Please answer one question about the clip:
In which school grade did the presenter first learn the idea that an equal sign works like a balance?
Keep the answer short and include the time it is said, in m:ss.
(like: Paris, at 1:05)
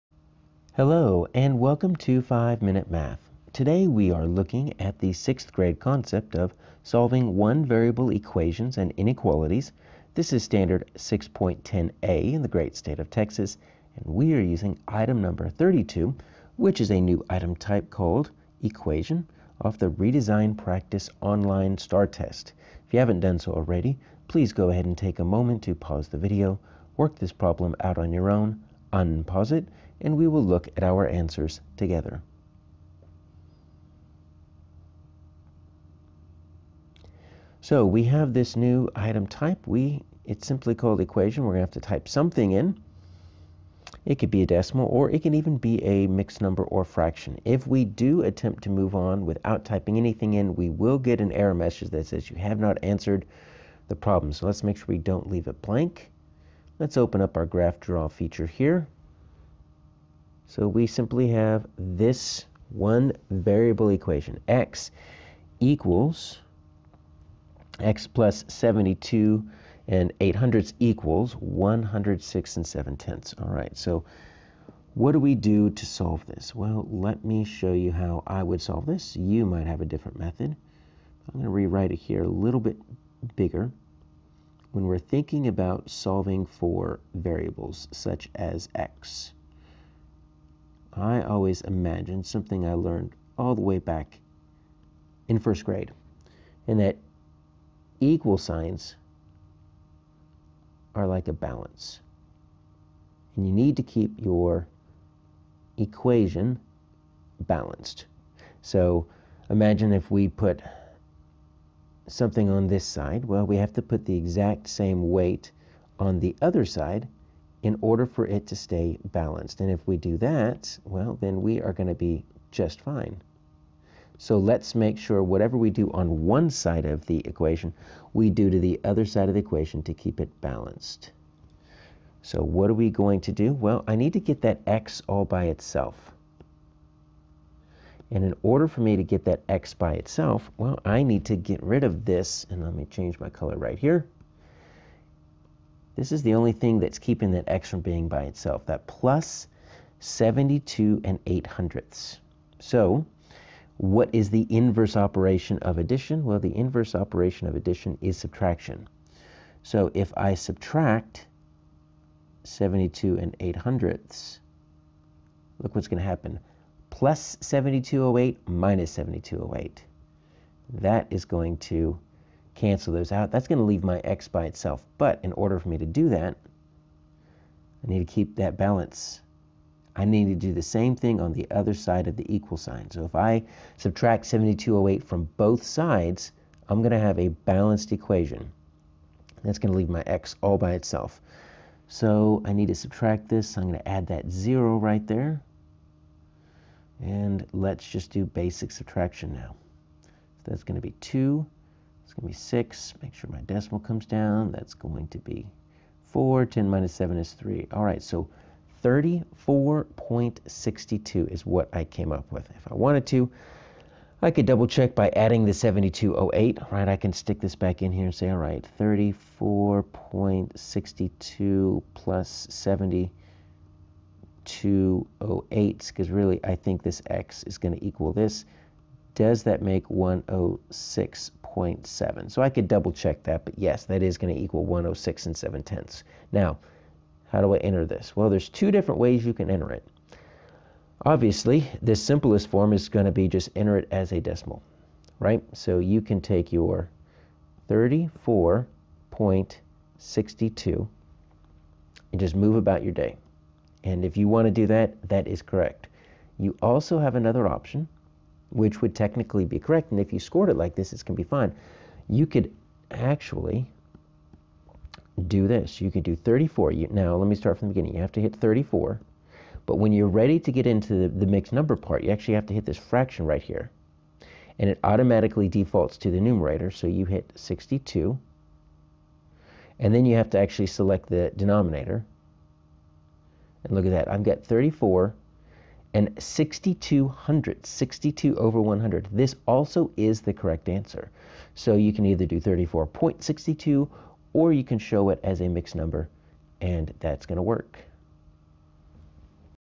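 first grade, at 1:35.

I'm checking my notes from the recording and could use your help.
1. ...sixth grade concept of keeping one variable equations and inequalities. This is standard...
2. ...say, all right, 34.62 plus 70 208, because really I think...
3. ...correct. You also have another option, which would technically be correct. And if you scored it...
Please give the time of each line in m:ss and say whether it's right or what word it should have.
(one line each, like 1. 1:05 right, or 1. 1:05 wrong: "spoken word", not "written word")
1. 0:05 wrong: "solving", not "keeping"
2. 3:38 right
3. 4:15 right.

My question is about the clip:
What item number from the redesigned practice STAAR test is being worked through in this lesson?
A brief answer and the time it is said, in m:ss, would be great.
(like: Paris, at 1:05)
32, at 0:15.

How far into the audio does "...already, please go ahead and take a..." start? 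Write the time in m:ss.
0:23.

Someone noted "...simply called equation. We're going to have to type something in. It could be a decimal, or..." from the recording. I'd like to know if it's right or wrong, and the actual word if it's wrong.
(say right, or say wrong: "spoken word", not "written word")
right.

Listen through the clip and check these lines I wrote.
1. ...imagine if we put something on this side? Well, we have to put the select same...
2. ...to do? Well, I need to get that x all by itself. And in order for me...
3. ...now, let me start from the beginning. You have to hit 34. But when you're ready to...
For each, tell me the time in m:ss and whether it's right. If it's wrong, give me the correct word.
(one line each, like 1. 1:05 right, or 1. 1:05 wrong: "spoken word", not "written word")
1. 1:49 wrong: "exact", not "select"
2. 2:13 right
3. 4:26 right.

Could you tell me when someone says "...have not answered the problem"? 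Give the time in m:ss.
0:52.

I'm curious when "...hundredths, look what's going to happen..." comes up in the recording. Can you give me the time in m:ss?
2:43.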